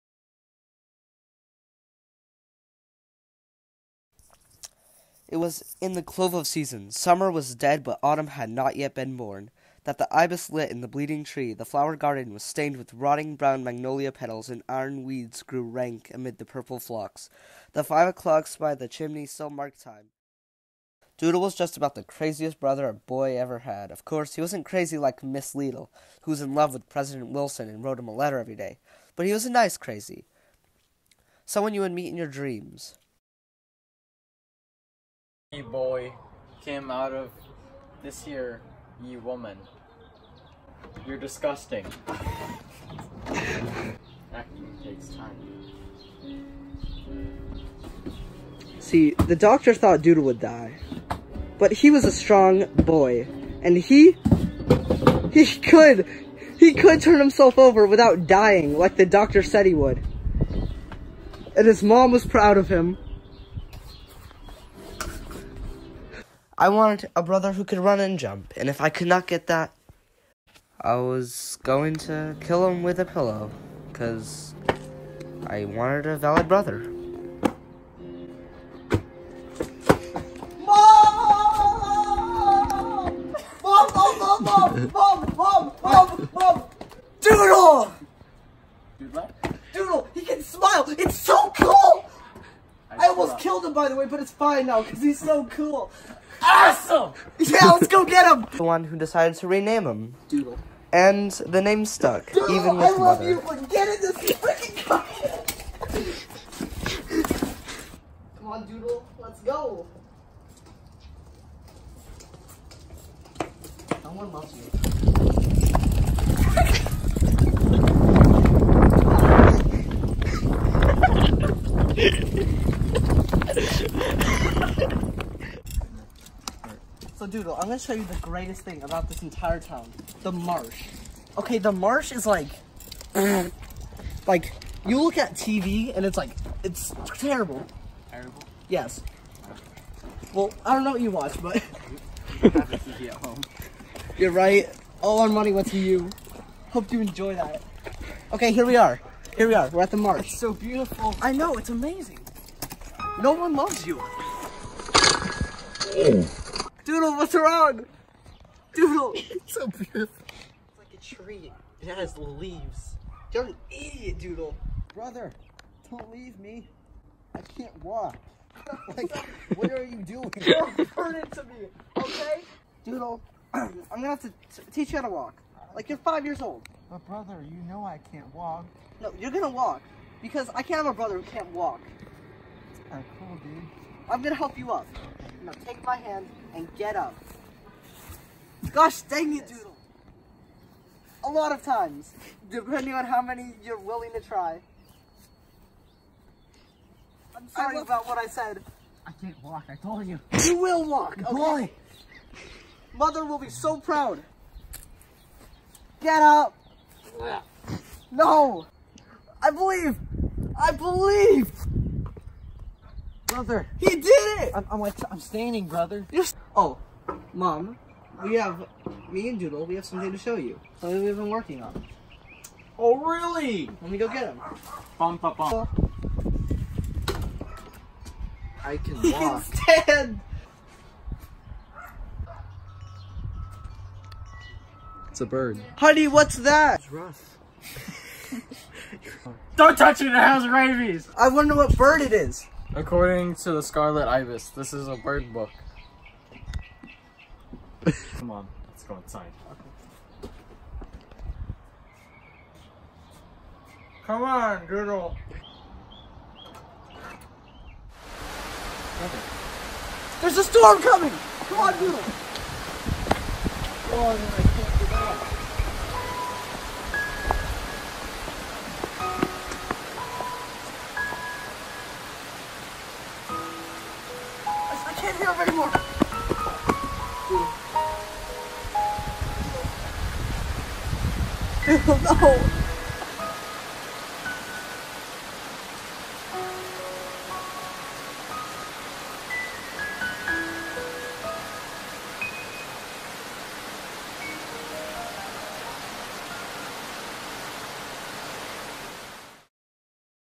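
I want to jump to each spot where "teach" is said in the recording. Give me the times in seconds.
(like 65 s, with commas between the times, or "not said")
174 s.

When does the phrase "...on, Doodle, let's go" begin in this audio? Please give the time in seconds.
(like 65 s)
108 s.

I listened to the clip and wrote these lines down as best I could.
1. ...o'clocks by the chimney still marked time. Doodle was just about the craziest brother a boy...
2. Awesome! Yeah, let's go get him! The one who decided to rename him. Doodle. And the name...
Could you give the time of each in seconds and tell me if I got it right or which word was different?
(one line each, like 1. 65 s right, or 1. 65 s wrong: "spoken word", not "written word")
1. 18 s right
2. 96 s right.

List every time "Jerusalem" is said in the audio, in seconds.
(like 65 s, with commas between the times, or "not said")
not said.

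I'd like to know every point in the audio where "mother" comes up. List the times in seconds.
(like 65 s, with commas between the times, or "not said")
103 s, 202 s.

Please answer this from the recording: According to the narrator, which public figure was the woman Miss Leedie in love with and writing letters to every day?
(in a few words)
President Wilson.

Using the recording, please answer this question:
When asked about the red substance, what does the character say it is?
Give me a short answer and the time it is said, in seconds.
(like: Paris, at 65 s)
Rust, at 236 s.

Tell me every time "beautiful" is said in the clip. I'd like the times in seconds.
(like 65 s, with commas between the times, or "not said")
150 s, 159 s.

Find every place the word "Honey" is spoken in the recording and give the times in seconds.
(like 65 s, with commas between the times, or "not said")
235 s.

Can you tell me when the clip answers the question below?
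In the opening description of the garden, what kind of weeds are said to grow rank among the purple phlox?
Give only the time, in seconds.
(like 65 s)
14 s.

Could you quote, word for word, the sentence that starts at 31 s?
Someone you would meet in your dreams ye boy came out of this here ye woman.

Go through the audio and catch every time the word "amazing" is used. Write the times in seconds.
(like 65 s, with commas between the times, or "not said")
151 s.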